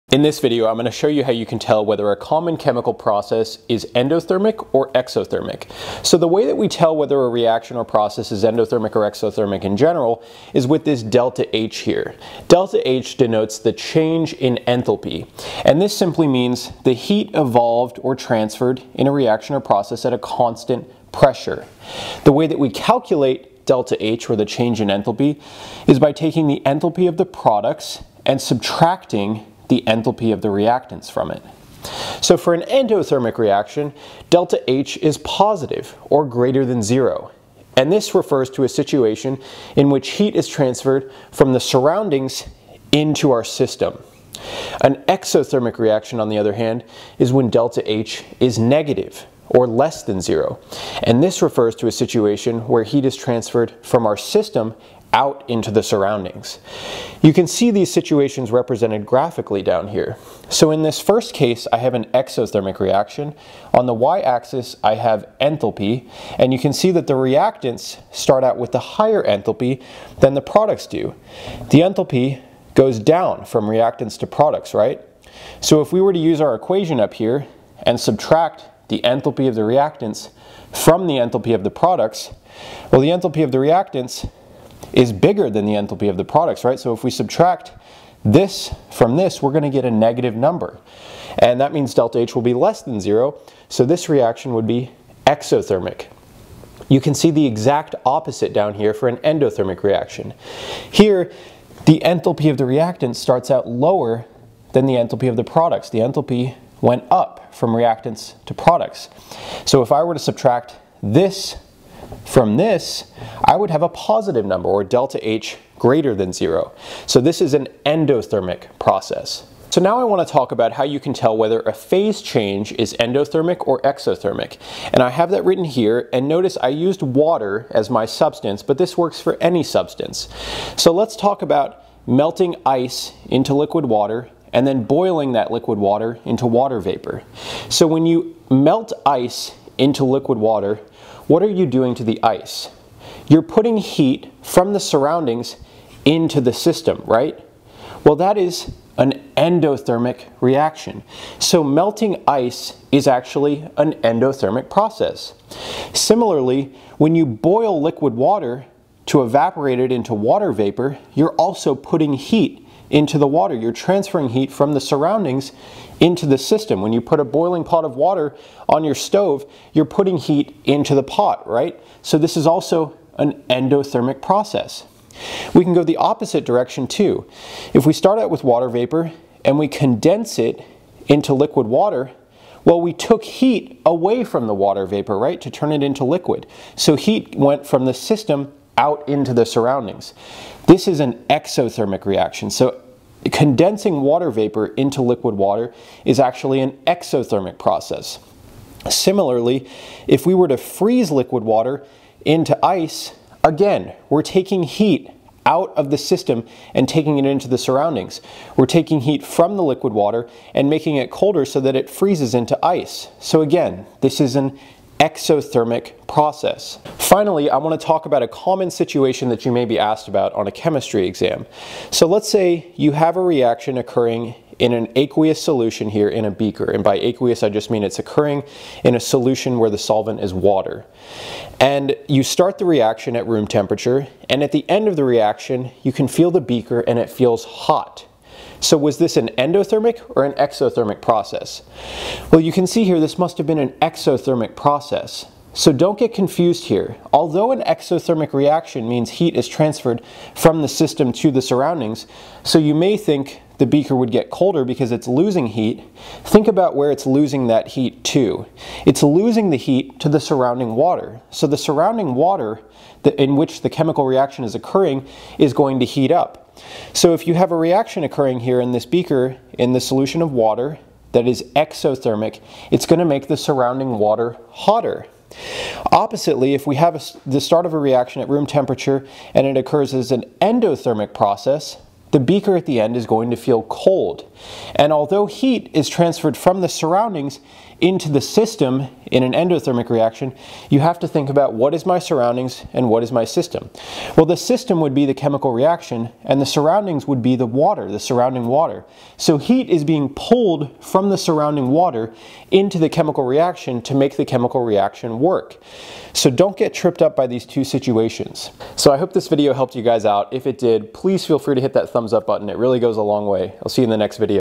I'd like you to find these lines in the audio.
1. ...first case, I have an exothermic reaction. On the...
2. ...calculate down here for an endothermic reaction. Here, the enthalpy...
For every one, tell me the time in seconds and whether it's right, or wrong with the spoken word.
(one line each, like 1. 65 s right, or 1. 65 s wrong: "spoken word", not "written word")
1. 60 s right
2. 98 s wrong: "opposite", not "calculate".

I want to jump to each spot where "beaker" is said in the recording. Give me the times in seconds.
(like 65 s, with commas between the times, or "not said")
226 s, 236 s, 253 s, 268 s, 282 s.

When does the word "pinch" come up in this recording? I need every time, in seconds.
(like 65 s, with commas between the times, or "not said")
not said.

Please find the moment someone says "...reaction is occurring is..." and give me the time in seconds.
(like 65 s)
264 s.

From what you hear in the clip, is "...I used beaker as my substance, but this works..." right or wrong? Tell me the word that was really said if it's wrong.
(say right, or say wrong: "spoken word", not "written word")
wrong: "water", not "beaker".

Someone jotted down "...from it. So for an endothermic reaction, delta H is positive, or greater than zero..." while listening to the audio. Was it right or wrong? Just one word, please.
right.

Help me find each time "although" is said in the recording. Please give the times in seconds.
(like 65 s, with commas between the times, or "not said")
247 s, 284 s.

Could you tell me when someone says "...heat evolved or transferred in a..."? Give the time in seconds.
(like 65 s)
16 s.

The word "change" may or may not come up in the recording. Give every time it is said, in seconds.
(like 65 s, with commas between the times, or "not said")
13 s, 24 s, 122 s.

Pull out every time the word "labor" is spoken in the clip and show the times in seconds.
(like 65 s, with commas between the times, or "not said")
not said.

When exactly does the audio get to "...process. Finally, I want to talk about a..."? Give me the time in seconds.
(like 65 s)
216 s.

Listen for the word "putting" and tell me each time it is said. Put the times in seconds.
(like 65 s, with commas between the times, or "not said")
143 s, 161 s, 169 s.